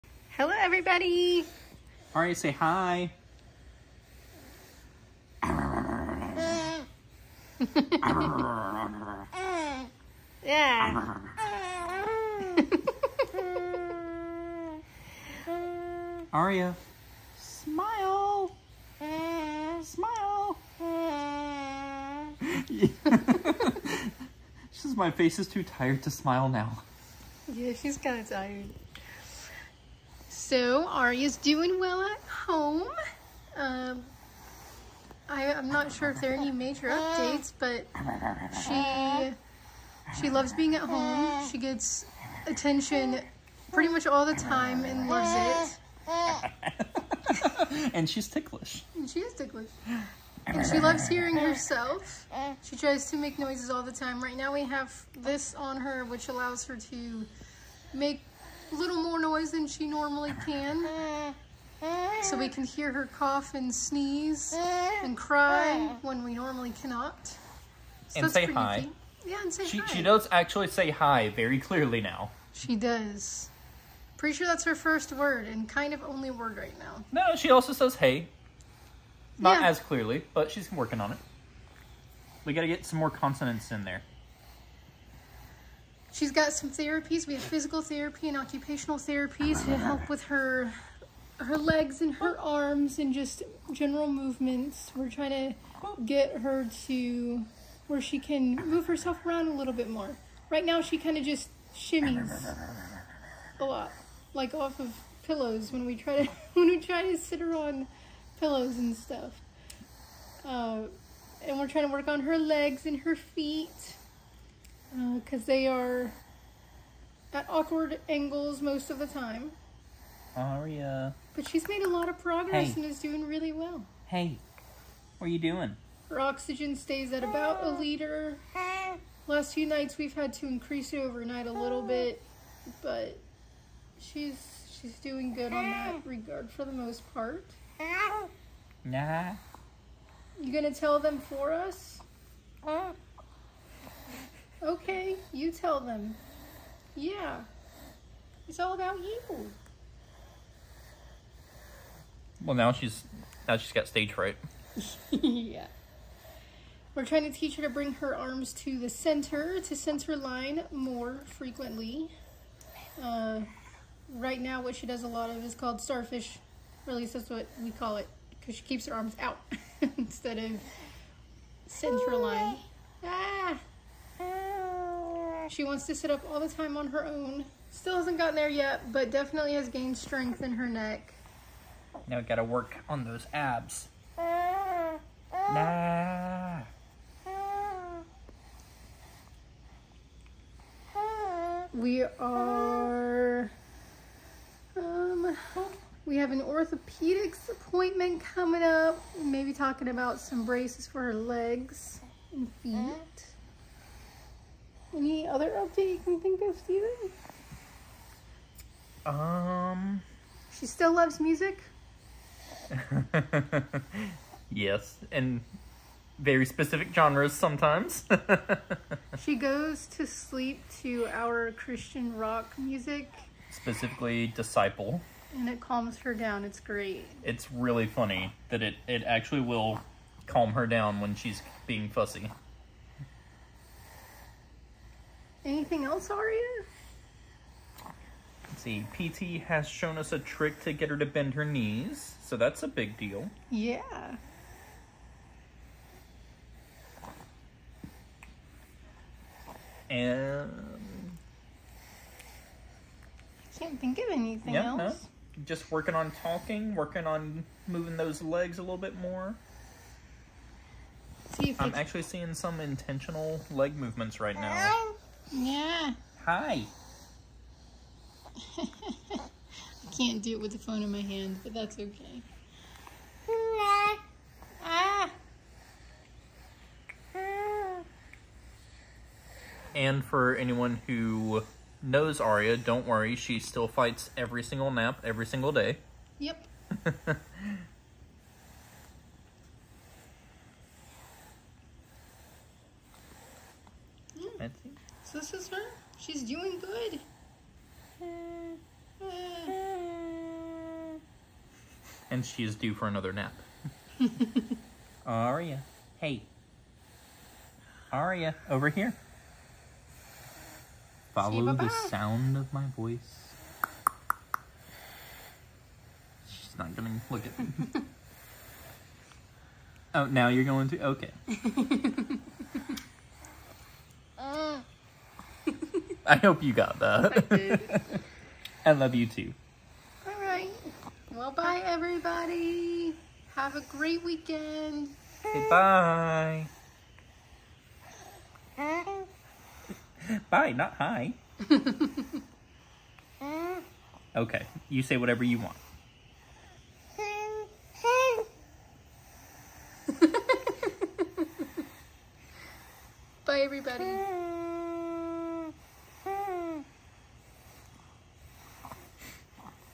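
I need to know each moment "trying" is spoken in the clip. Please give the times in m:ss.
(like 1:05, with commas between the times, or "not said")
1:35, 1:51, 2:37.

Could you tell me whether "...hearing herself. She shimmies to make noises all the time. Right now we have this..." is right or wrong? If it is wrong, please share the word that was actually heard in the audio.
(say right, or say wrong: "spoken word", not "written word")
wrong: "tries", not "shimmies".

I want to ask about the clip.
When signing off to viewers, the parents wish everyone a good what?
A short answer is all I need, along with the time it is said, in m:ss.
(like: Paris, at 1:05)
weekend, at 5:34.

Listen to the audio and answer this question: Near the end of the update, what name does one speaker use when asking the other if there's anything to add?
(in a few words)
Steven.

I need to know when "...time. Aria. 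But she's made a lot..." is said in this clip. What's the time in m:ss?
1:59.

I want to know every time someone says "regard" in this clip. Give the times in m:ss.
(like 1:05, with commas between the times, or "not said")
2:16.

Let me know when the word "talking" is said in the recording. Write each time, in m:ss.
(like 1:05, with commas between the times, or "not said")
3:19, 4:16.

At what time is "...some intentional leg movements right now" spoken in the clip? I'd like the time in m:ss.
4:22.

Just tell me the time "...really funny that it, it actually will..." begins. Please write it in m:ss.
3:47.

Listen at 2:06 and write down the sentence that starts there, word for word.
Her oxygen stays at about a liter.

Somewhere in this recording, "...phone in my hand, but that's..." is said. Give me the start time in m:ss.
4:30.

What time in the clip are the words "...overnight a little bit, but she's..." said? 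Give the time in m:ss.
2:10.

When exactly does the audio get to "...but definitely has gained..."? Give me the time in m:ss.
2:58.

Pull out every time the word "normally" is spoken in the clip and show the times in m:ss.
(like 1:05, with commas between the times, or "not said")
0:59, 1:06.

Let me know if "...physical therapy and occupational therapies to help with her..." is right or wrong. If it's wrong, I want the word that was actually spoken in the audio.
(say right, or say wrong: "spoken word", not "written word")
right.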